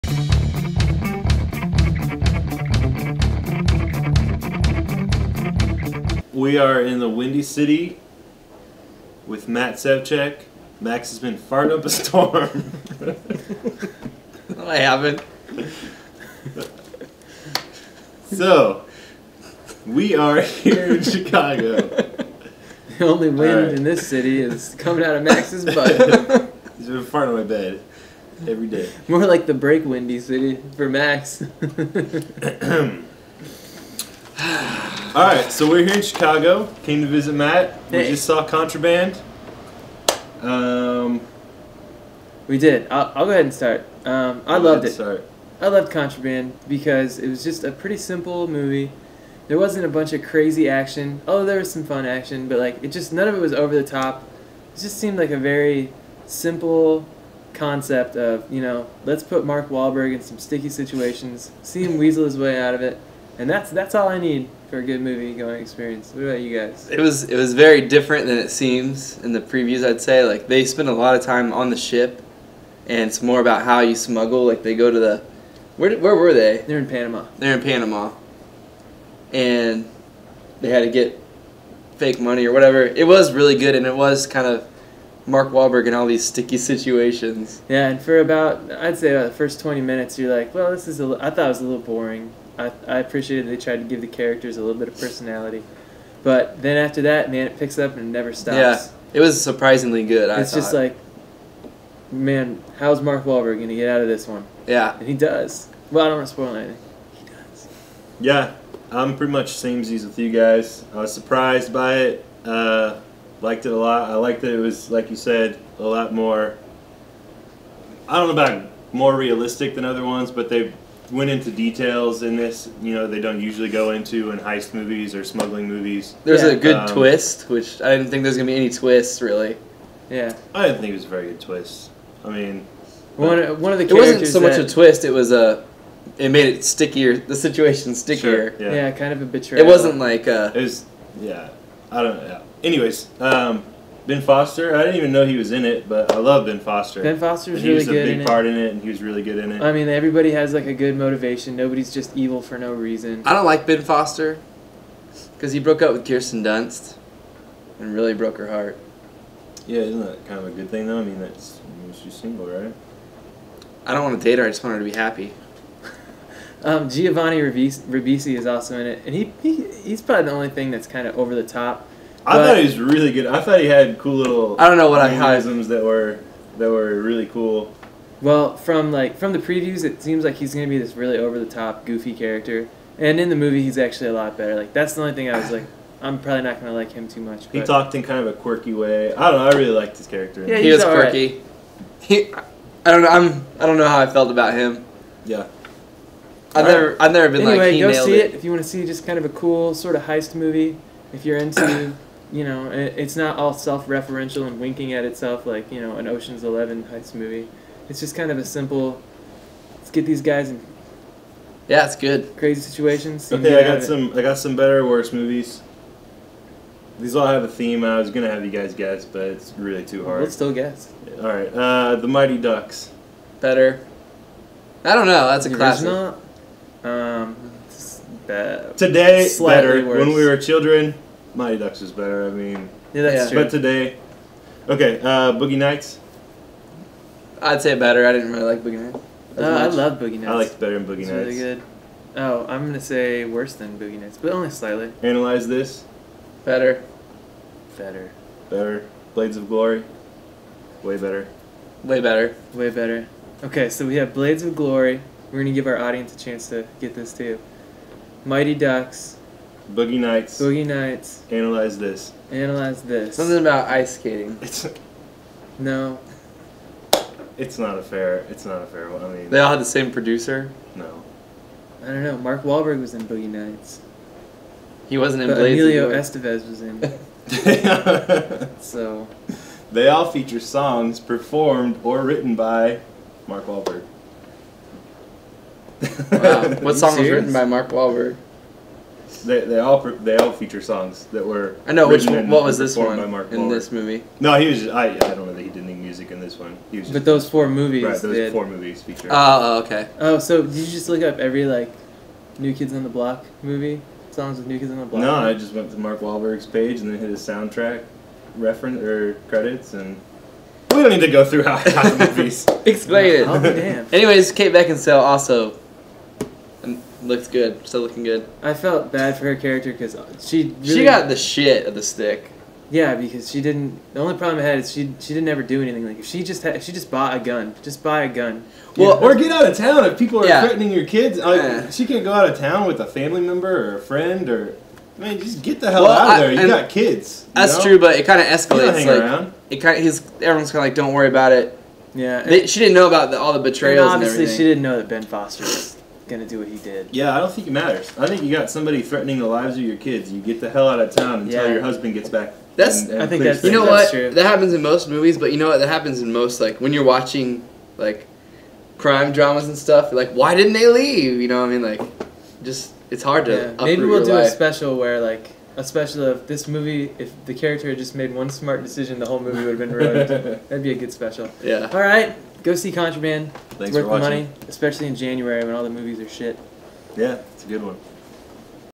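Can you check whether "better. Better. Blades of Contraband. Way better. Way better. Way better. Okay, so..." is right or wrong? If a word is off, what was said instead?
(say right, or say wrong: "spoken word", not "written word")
wrong: "Glory", not "Contraband".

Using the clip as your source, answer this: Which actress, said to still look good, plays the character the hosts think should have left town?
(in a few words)
Kate Beckinsale.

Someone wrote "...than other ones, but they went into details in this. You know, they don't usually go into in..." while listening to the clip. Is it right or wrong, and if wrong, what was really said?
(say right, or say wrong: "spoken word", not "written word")
right.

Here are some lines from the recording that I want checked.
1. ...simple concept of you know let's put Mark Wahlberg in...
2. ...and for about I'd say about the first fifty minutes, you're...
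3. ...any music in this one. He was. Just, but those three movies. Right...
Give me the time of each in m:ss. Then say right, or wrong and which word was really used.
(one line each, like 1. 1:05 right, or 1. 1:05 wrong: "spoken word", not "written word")
1. 0:56 right
2. 1:27 wrong: "twenty", not "fifty"
3. 4:55 wrong: "four", not "three".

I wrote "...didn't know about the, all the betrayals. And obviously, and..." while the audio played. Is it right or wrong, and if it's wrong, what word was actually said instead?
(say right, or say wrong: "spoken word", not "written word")
right.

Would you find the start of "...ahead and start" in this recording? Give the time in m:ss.
0:43.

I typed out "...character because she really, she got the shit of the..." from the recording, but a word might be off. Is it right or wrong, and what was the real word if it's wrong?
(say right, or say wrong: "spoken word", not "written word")
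right.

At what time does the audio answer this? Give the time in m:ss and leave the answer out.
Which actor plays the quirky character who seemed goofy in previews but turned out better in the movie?
2:46.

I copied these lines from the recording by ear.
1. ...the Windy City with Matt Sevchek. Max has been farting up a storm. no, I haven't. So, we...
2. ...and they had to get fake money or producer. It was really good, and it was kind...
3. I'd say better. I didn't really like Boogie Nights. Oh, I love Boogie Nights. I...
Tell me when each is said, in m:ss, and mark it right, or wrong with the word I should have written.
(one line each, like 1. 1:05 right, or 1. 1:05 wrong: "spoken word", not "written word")
1. 0:06 right
2. 1:19 wrong: "whatever", not "producer"
3. 3:57 right.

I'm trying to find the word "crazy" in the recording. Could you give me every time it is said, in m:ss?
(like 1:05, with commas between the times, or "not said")
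0:50, 3:32.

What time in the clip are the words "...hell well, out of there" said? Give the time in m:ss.
5:35.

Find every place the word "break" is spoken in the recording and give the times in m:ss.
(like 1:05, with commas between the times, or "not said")
0:29.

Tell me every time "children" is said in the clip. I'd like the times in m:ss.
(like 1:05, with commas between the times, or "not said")
3:50.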